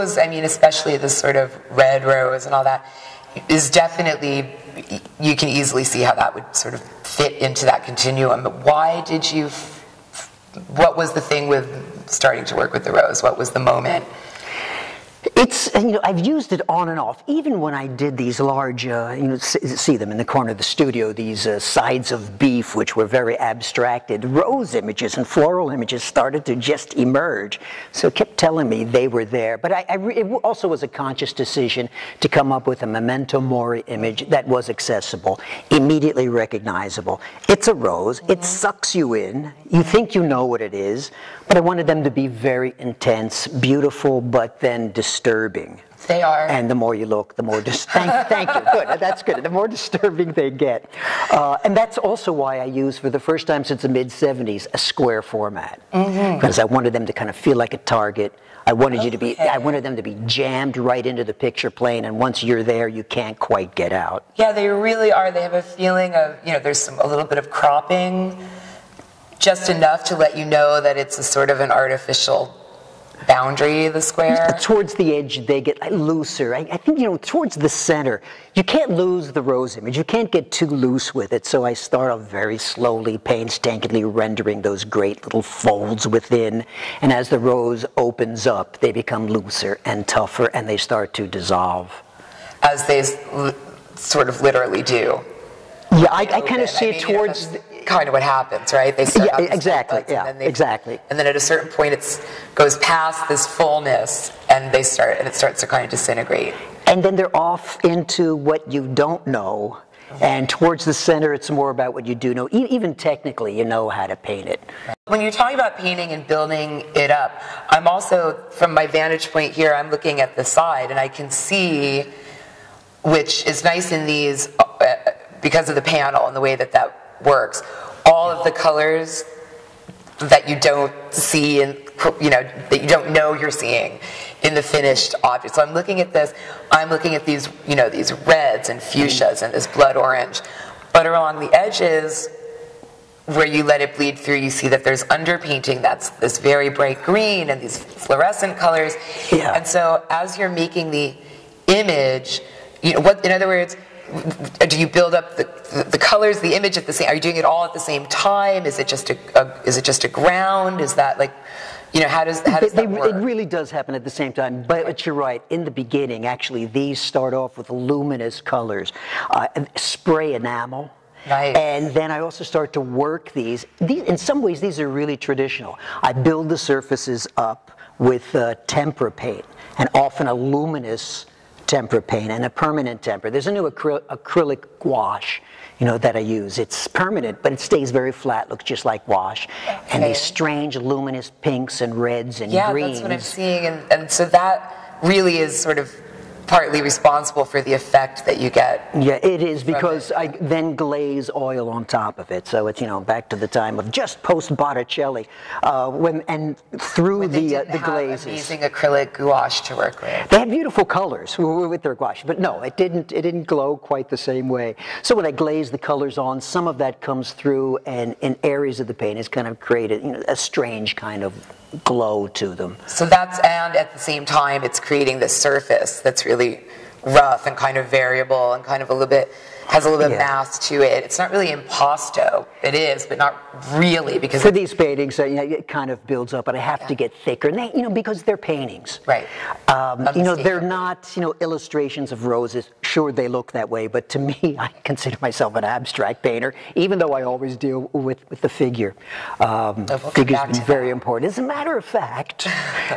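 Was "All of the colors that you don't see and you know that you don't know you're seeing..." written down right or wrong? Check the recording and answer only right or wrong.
right.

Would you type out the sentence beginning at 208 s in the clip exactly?
Amazing acrylic gouache to work with.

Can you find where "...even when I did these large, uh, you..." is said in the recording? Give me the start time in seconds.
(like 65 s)
17 s.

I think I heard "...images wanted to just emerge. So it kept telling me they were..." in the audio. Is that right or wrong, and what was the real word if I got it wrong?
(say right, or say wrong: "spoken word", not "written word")
wrong: "started", not "wanted".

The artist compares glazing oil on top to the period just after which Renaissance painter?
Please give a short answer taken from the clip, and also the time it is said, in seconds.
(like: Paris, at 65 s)
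Botticelli, at 204 s.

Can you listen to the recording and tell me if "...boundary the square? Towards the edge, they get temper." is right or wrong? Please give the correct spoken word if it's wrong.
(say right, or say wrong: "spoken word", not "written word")
wrong: "looser", not "temper".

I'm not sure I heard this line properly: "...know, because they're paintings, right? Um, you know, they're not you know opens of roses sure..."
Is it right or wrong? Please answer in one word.
wrong.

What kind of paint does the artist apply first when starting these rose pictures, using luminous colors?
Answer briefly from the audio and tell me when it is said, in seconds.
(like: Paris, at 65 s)
spray enamel, at 169 s.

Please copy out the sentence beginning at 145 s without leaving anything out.
That's this very bright green and these fluorescent colors.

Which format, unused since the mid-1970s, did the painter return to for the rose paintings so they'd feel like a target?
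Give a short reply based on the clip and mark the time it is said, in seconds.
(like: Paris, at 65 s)
square format, at 54 s.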